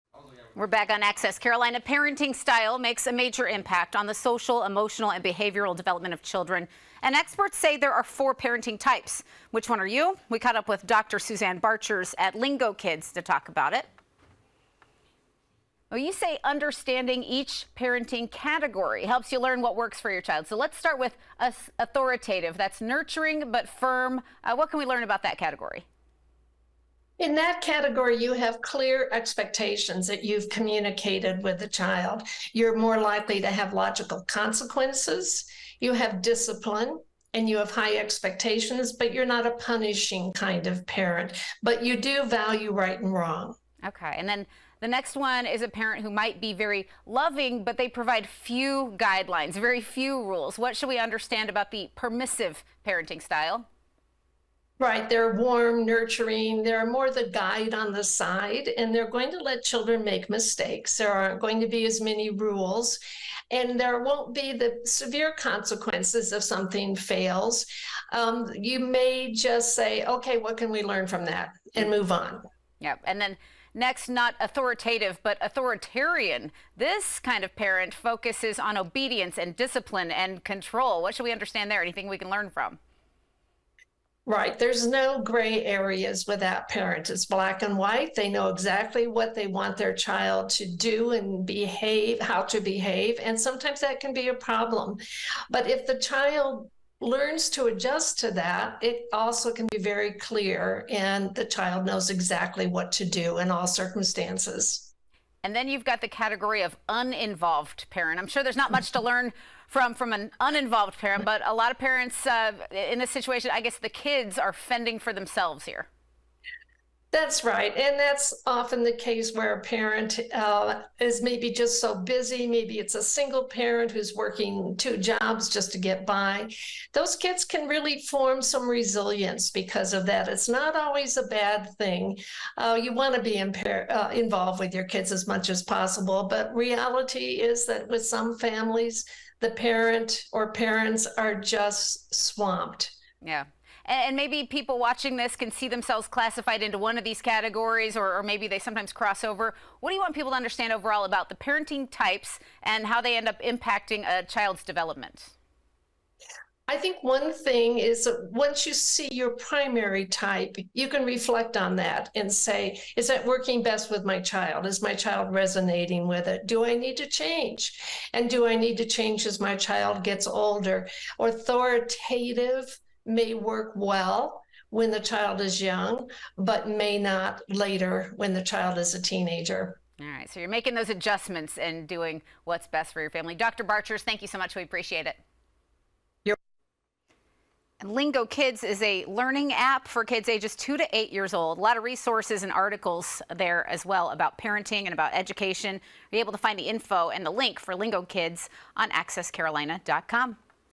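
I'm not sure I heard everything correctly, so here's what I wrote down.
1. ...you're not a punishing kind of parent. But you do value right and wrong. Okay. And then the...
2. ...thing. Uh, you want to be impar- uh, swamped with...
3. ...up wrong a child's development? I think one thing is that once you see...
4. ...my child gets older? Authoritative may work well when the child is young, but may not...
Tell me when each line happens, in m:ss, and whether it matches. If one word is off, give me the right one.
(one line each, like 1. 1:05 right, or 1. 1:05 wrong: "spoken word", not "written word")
1. 0:39 right
2. 2:11 wrong: "involved", not "swamped"
3. 2:33 wrong: "impacting", not "wrong"
4. 2:49 right.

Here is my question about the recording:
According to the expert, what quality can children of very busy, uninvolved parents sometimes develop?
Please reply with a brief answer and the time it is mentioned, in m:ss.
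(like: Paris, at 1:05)
Resilience, at 2:08.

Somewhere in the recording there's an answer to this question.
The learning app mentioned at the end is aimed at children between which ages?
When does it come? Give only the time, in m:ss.
3:10.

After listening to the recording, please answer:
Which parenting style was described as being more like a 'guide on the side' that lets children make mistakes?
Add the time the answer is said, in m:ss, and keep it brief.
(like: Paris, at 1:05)
Permissive, at 0:51.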